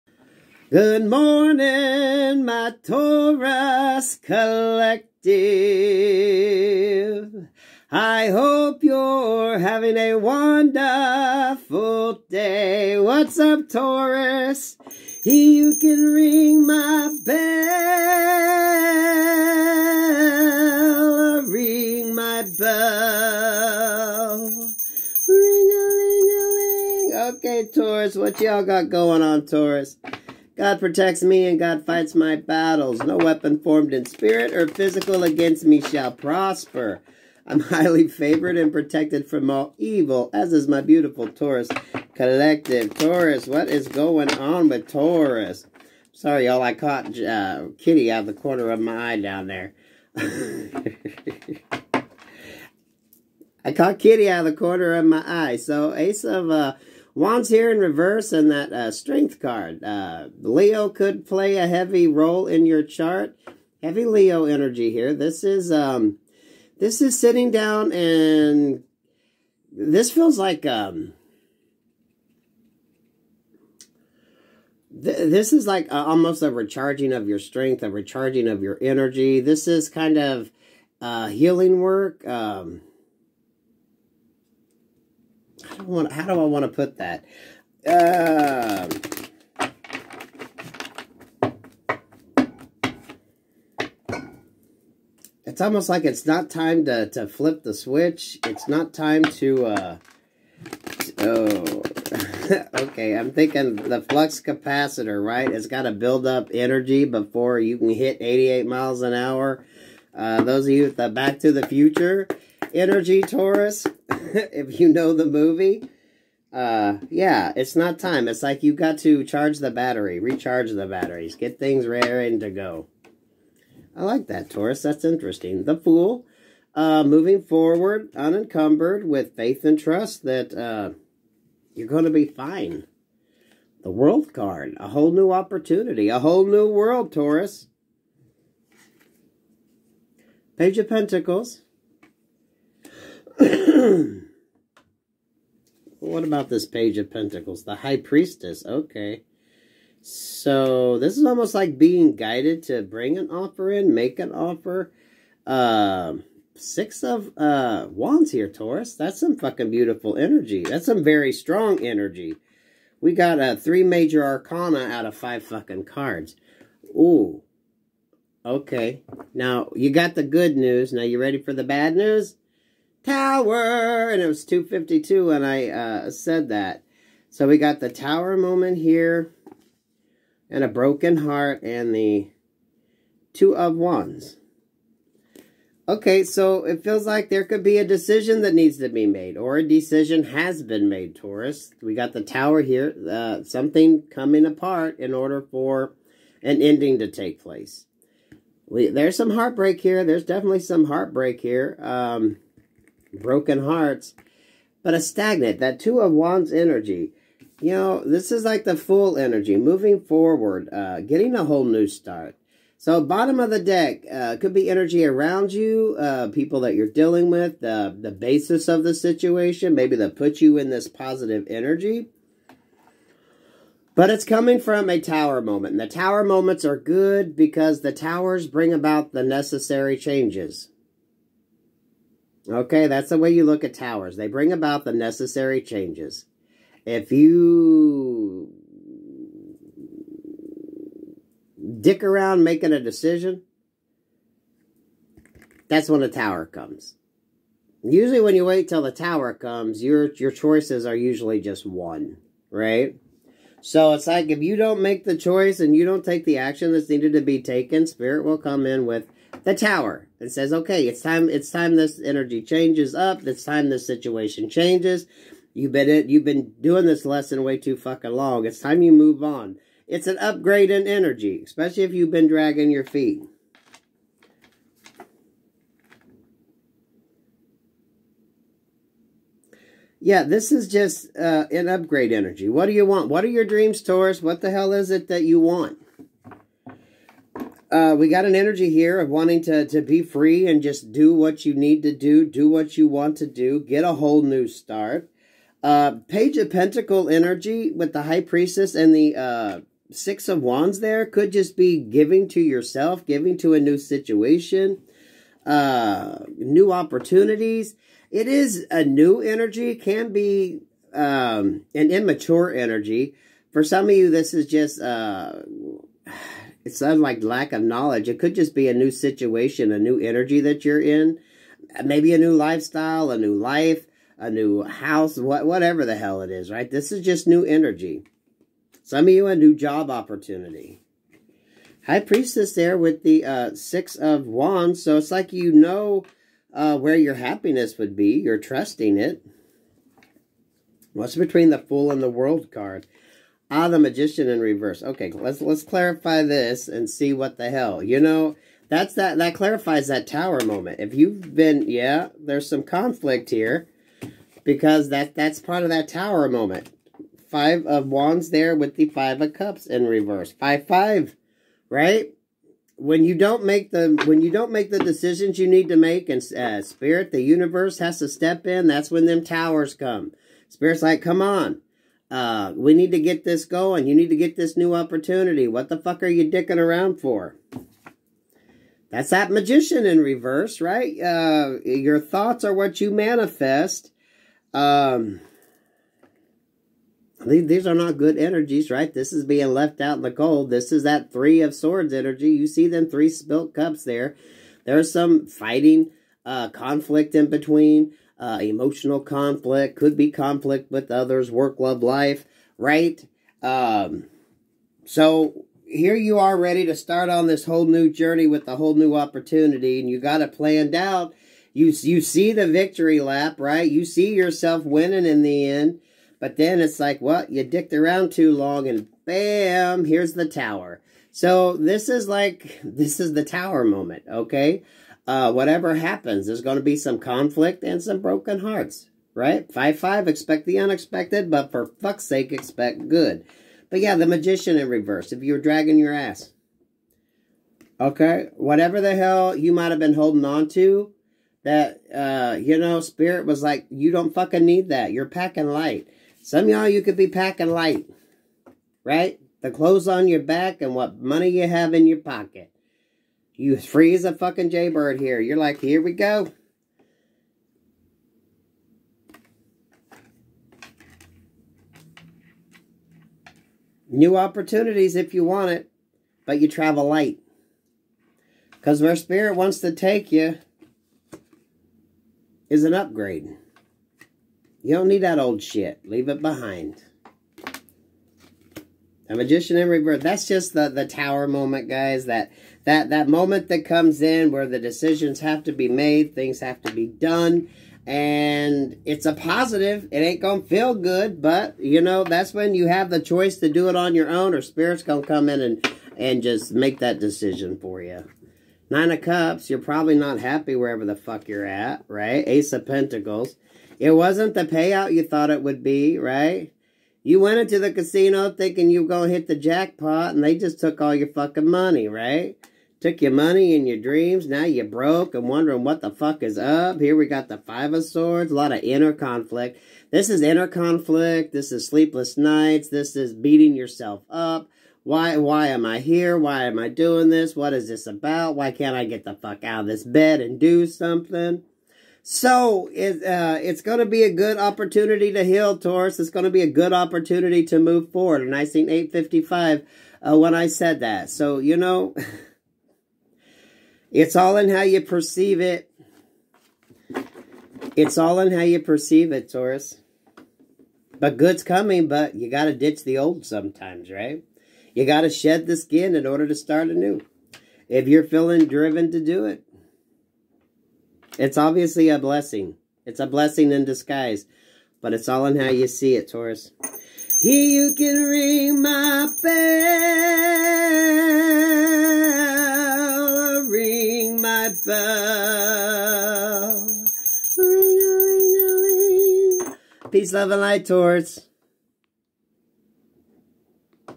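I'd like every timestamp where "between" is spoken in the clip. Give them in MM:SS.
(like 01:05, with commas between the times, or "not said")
05:41, 06:37.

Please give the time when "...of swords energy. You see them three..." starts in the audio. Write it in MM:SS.
06:31.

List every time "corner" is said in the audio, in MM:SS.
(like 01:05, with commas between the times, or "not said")
00:48, 00:54.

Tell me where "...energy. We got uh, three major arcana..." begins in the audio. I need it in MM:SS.
02:41.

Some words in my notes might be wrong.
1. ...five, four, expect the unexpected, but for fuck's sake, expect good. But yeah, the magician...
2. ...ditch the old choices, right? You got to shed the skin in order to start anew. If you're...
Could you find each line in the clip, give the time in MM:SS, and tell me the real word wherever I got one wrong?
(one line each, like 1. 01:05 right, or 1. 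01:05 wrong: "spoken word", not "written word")
1. 07:09 wrong: "five", not "four"
2. 09:12 wrong: "sometimes", not "choices".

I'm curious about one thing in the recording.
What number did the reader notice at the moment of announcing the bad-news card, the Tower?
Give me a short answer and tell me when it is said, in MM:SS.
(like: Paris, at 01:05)
252, at 02:54.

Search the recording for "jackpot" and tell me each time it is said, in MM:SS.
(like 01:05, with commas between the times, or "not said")
08:29.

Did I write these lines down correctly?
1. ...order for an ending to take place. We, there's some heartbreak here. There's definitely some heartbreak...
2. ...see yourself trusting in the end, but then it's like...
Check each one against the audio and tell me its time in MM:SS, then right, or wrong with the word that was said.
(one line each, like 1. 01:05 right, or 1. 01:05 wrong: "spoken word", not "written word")
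1. 03:15 right
2. 06:53 wrong: "winning", not "trusting".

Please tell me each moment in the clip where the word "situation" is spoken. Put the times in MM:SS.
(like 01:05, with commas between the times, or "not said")
03:38, 04:23, 05:03, 05:18.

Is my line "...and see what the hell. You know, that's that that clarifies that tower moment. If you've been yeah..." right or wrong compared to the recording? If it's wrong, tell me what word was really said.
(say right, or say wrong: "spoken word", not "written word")
right.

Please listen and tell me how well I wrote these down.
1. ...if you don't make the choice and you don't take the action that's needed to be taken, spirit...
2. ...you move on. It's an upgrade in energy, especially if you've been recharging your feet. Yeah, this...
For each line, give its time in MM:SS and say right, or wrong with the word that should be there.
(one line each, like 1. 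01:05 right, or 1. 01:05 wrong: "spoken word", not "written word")
1. 04:14 right
2. 04:28 wrong: "dragging", not "recharging".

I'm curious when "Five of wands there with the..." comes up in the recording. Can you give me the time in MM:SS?
05:57.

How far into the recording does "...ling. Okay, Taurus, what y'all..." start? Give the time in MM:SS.
00:26.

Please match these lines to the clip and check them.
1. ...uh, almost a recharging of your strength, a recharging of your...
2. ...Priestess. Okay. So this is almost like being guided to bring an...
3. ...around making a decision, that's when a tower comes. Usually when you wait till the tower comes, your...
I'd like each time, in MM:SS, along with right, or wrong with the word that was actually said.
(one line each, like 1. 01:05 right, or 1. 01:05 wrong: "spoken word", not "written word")
1. 01:15 right
2. 02:27 right
3. 04:02 right.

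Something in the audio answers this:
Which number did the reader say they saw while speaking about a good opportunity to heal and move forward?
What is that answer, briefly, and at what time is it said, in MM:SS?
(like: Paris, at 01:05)
855, at 08:58.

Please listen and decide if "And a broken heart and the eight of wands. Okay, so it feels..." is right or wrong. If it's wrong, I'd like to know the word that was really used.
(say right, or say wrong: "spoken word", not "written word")
wrong: "two", not "eight".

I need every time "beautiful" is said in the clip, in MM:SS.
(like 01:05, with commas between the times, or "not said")
00:40, 02:39.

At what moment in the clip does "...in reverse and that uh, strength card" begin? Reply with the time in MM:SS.
00:57.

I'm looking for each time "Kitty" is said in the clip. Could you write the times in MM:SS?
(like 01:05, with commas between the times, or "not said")
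00:47, 00:53.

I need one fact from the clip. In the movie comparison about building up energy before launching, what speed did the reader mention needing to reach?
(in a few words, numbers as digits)
88 miles an hour.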